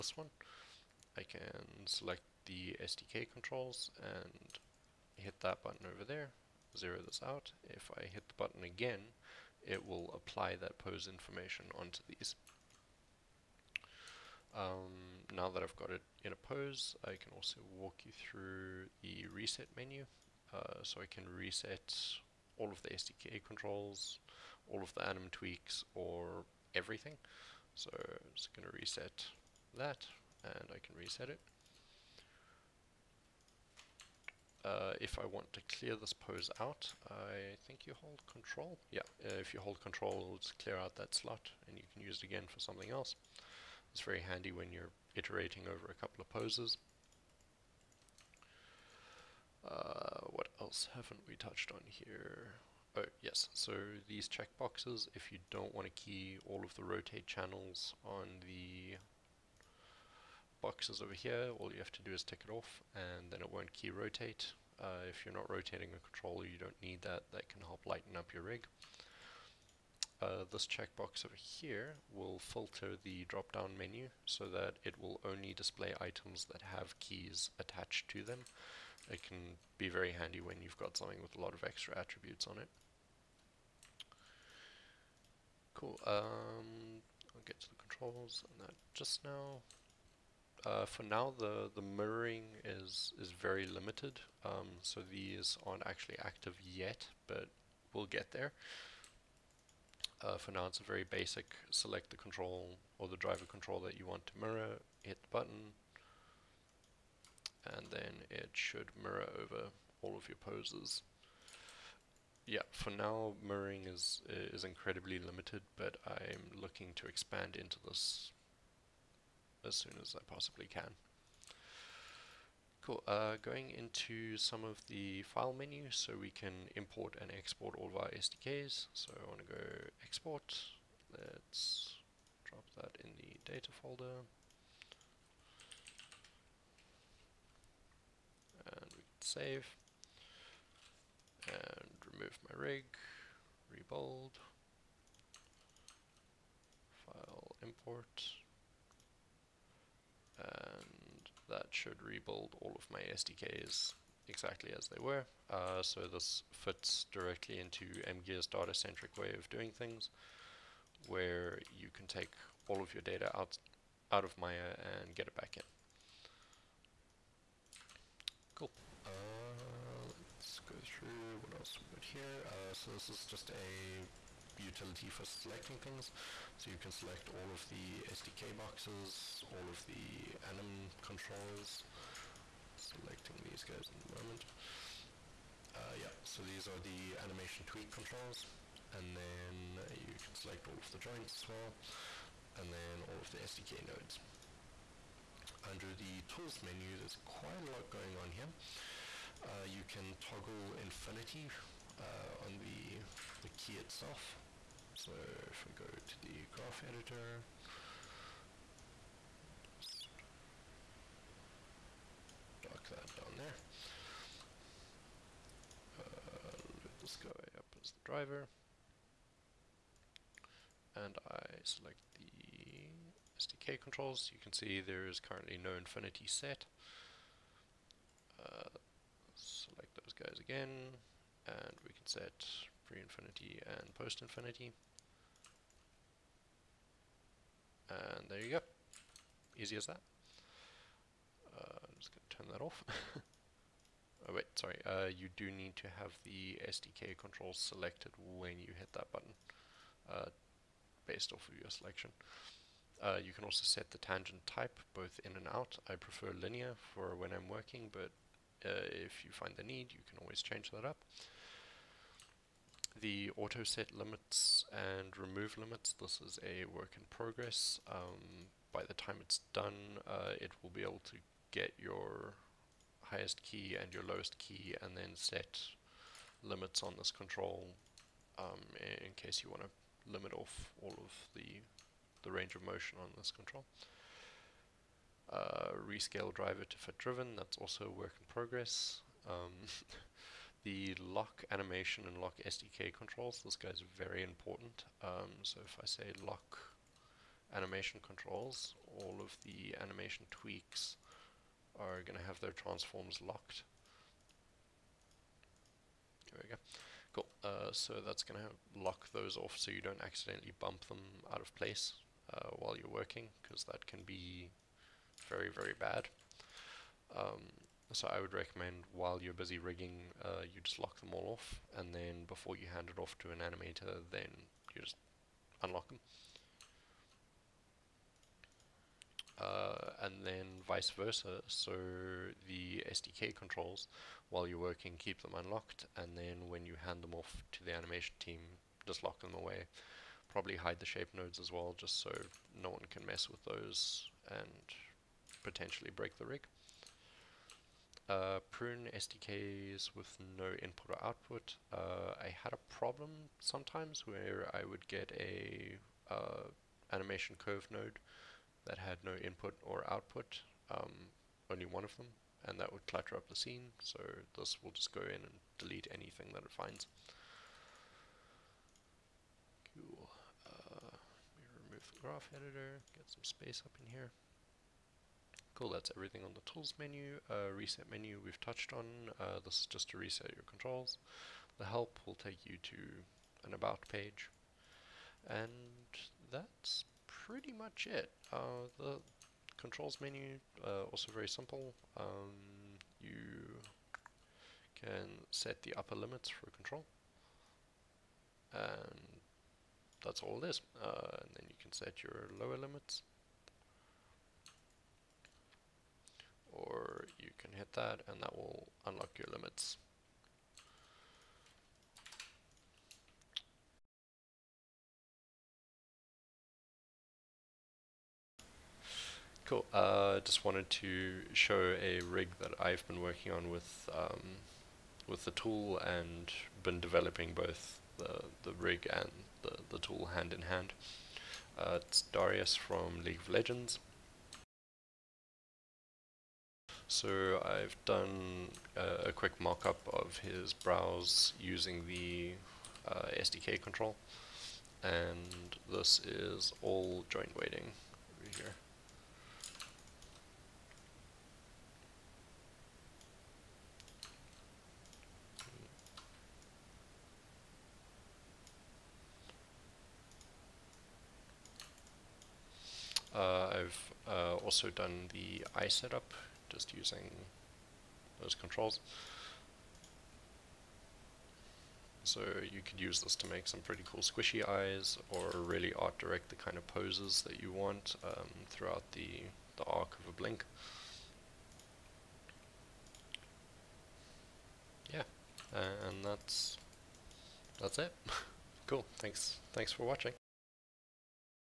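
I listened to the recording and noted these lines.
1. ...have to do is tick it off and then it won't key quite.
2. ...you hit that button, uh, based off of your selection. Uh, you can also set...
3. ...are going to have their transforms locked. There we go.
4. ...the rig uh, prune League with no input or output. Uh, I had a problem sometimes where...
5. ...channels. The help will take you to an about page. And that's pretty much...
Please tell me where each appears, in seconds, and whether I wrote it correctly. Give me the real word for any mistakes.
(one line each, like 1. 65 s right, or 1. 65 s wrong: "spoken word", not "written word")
1. 61 s wrong: "rotate", not "quite"
2. 248 s right
3. 301 s right
4. 346 s wrong: "SDKs", not "League"
5. 380 s wrong: "controls", not "channels".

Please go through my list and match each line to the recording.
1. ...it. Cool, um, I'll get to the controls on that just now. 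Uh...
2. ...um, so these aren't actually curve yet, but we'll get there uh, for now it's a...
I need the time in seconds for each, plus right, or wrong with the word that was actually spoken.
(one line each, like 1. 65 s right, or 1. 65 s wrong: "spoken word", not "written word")
1. 82 s right
2. 94 s wrong: "active", not "curve".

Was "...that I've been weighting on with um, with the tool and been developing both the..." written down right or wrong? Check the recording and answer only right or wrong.
wrong.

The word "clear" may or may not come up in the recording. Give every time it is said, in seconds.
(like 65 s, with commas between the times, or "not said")
35 s, 40 s.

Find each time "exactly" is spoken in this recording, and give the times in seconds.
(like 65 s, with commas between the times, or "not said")
154 s.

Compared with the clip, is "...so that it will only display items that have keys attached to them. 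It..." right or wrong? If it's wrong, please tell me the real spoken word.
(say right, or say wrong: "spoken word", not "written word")
right.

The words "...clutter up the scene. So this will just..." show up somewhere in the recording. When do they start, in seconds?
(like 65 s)
362 s.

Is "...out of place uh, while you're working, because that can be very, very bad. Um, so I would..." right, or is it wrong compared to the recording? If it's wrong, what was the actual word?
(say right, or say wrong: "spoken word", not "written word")
right.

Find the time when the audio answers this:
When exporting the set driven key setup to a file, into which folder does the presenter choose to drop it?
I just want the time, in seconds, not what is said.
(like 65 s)
133 s.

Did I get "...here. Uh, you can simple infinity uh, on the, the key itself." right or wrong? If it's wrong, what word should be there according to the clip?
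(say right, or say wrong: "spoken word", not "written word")
wrong: "toggle", not "simple".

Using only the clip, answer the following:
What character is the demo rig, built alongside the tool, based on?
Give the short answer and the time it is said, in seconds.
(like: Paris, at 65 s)
Darius, at 432 s.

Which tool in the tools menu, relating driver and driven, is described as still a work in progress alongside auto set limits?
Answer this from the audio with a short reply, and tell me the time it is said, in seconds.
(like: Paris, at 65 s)
rescale driver to fit driven, at 285 s.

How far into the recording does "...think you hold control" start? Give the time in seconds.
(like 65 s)
37 s.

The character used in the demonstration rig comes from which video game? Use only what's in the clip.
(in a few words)
League of Legends.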